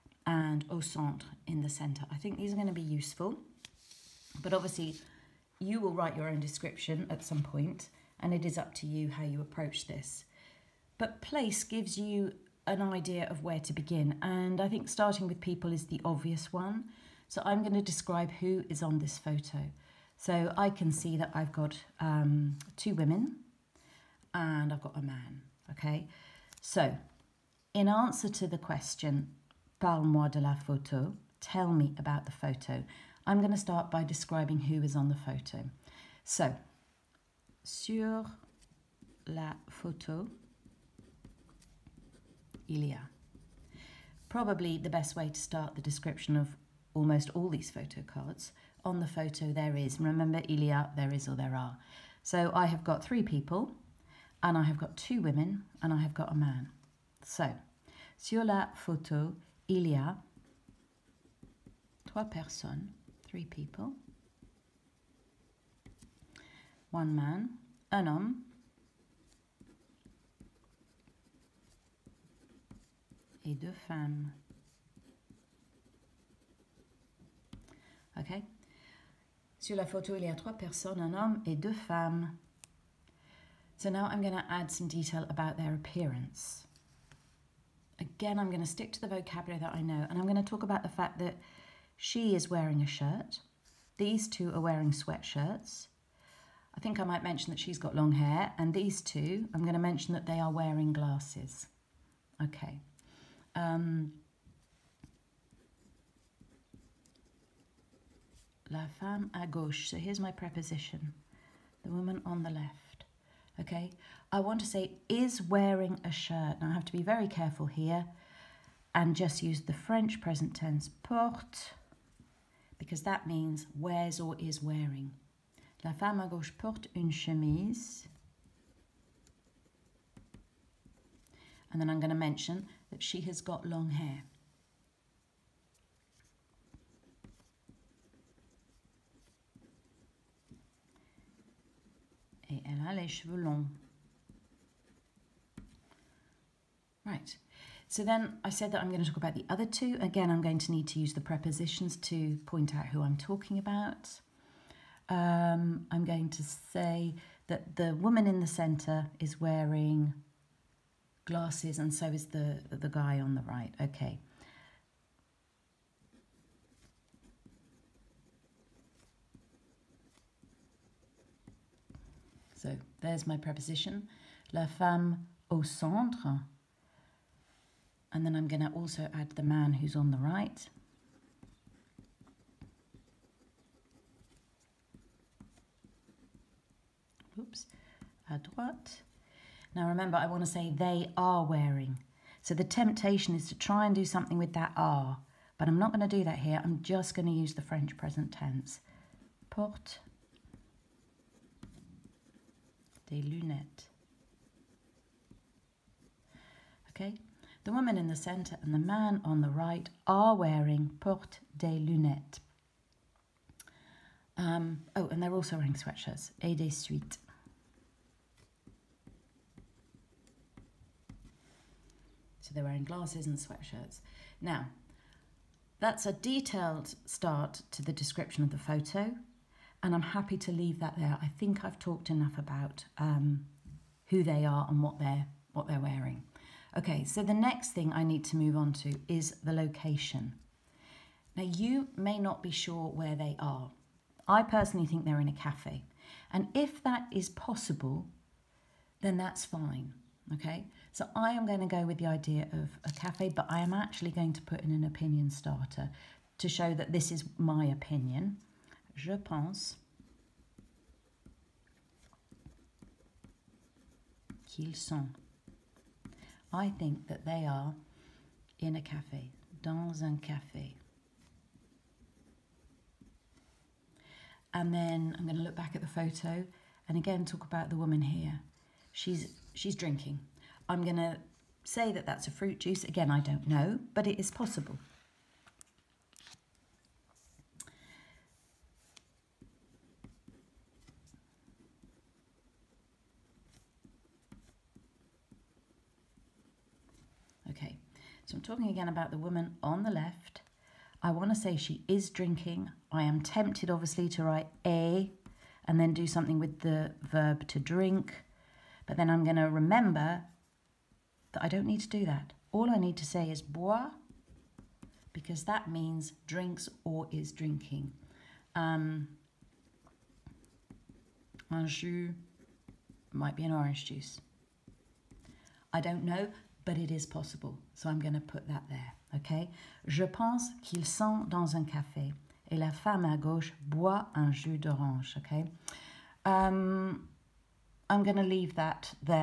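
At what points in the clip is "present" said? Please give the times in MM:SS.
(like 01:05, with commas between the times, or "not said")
02:00, 03:17.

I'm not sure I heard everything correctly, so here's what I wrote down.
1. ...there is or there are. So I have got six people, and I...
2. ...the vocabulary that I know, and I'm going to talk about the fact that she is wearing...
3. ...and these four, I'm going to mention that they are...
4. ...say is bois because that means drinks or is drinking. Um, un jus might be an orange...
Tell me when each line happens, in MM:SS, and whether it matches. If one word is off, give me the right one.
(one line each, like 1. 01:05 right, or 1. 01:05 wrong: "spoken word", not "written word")
1. 00:50 wrong: "three", not "six"
2. 01:29 right
3. 01:38 wrong: "two", not "four"
4. 05:13 right.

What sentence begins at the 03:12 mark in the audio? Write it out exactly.
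So the temptation is to try and do something with that are.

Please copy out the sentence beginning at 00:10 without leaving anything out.
But place gives you an idea of where to begin, and I think starting with people is the obvious one.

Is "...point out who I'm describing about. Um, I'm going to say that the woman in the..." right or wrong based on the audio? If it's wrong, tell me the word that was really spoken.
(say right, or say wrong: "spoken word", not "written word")
wrong: "talking", not "describing".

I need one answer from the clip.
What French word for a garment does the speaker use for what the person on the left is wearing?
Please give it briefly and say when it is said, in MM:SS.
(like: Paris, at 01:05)
une chemise, at 02:06.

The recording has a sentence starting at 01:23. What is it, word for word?
So now I'm going to add some detail about their appearance.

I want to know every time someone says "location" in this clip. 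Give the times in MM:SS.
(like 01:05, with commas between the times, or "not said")
03:59.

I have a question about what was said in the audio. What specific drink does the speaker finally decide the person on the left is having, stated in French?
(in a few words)
jus d'orange.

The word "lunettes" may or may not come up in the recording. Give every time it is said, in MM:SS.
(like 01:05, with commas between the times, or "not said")
03:23, 03:31.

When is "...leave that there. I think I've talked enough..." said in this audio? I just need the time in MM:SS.
03:50.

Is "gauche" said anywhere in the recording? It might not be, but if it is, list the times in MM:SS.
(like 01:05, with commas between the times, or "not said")
01:49, 02:06, 05:33.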